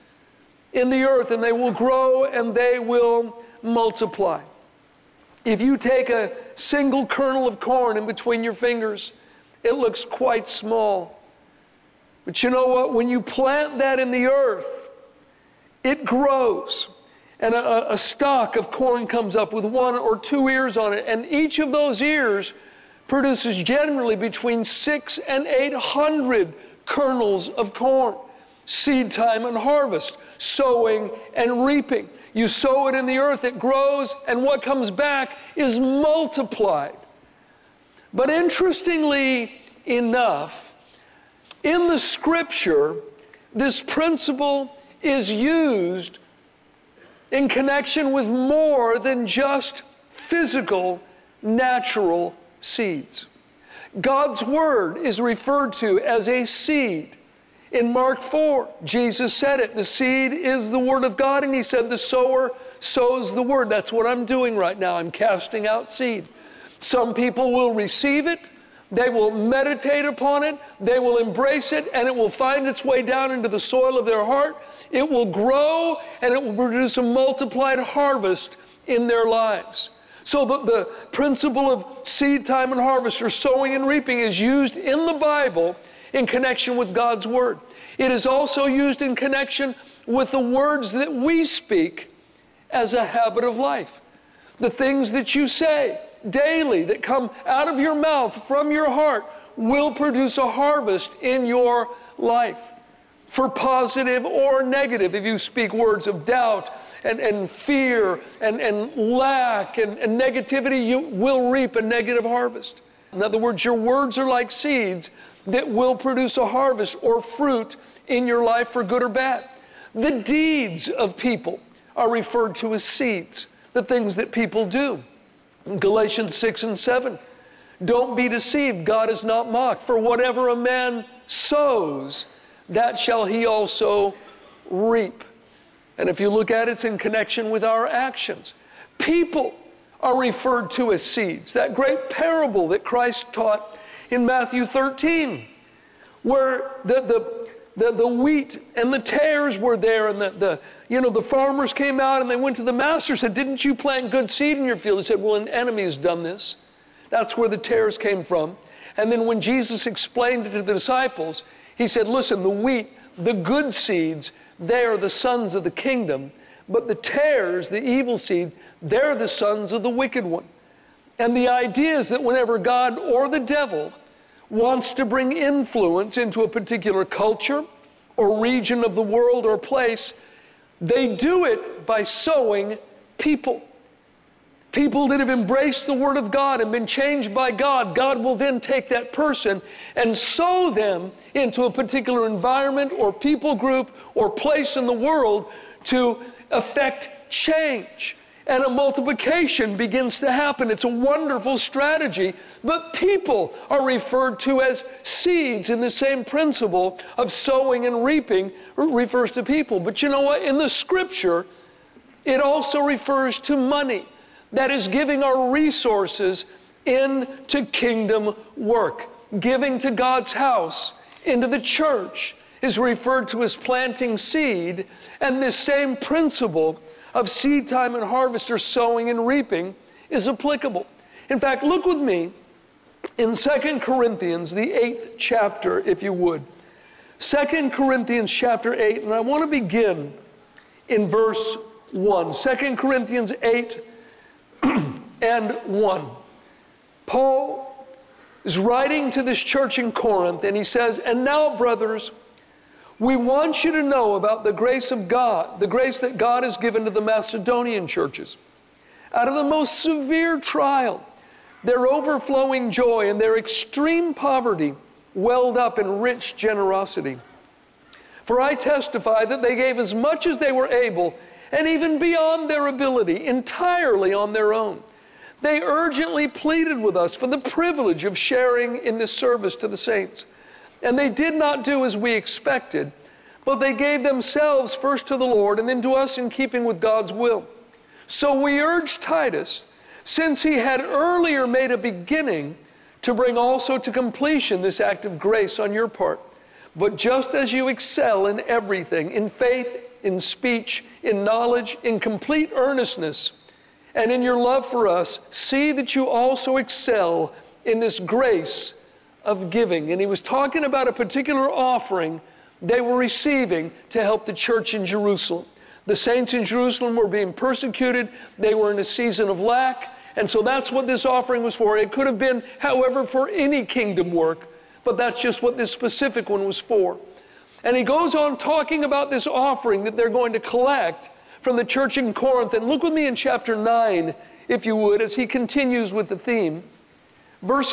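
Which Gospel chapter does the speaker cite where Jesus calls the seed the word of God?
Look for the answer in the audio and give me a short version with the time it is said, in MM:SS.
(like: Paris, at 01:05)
Mark 4, at 00:57.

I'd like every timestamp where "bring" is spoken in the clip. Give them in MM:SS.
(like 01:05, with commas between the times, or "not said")
02:55, 04:53.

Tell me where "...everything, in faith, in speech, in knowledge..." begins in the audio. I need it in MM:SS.
04:58.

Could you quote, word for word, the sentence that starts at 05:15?
The saints in Jerusalem were being persecuted, they were in a season of lack.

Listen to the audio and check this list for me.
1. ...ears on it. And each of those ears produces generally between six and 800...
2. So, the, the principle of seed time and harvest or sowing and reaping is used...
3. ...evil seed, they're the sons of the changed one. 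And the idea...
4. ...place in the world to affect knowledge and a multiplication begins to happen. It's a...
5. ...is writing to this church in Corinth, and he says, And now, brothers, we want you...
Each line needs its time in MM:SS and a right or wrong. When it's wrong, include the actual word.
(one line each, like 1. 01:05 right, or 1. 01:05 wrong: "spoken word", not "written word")
1. 00:20 right
2. 01:20 right
3. 02:47 wrong: "wicked", not "changed"
4. 03:14 wrong: "change", not "knowledge"
5. 04:08 right.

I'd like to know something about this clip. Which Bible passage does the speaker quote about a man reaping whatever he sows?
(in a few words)
Galatians 6 and 7.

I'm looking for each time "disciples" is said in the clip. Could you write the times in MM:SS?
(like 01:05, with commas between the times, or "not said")
02:40.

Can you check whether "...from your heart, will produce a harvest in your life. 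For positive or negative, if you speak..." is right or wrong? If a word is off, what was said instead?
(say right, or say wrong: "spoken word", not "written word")
right.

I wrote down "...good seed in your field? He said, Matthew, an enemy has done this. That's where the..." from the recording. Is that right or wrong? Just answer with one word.
wrong.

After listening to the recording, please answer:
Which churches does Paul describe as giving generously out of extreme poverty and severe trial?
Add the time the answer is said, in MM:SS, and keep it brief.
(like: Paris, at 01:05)
Macedonian churches, at 04:17.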